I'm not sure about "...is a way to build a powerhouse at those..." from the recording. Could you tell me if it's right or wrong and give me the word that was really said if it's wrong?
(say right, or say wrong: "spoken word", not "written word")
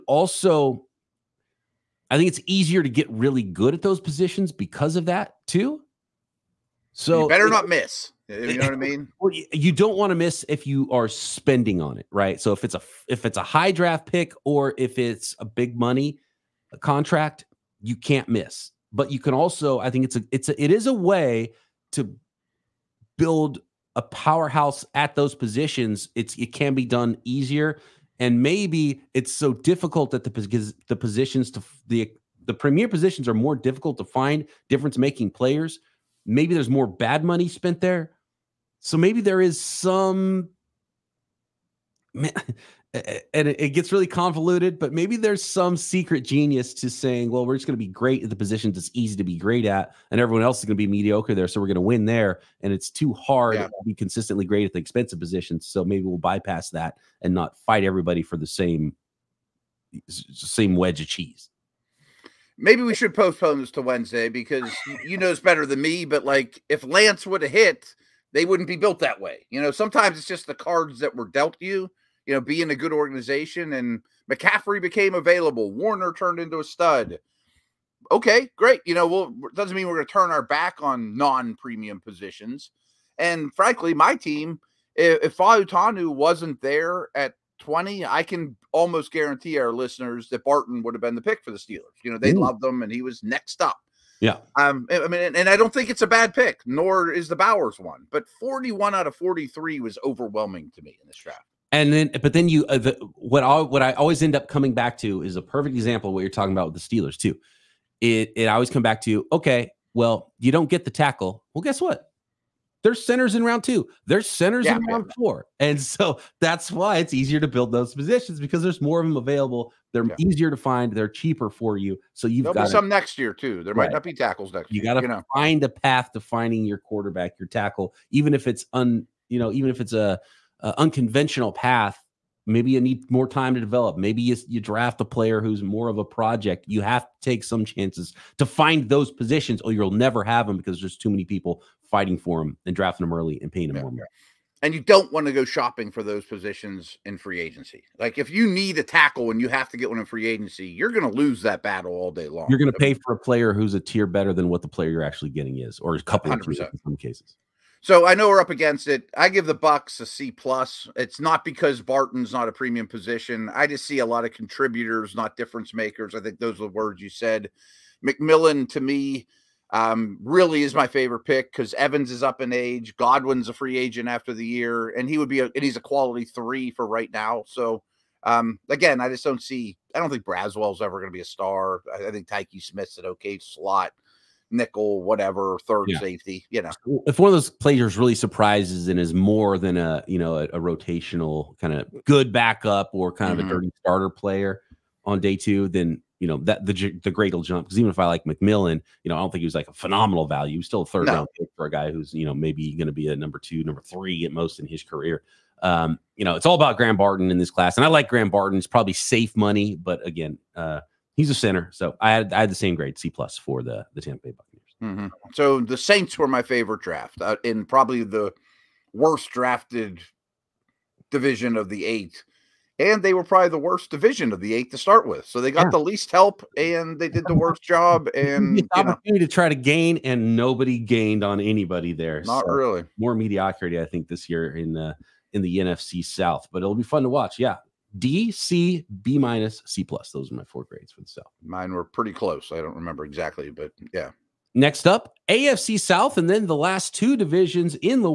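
right.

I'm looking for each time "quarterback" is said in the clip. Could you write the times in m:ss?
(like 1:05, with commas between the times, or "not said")
2:06.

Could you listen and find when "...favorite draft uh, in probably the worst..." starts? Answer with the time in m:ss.
3:36.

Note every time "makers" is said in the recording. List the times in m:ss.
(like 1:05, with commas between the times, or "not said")
2:45.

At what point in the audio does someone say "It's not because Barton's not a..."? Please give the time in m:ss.
2:40.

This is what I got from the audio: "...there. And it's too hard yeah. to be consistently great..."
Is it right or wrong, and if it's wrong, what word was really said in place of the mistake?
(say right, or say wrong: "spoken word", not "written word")
right.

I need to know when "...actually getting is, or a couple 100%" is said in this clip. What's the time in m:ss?
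2:35.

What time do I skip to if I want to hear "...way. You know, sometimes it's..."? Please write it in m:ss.
1:09.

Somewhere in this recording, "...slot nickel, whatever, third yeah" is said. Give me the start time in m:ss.
3:03.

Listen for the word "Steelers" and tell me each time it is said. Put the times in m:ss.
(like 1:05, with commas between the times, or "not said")
1:31, 1:46.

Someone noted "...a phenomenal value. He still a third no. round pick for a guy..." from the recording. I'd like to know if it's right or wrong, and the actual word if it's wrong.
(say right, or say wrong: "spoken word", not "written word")
right.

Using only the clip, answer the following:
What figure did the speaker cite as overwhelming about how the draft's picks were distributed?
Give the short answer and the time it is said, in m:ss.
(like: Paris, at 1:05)
41 out of 43, at 1:38.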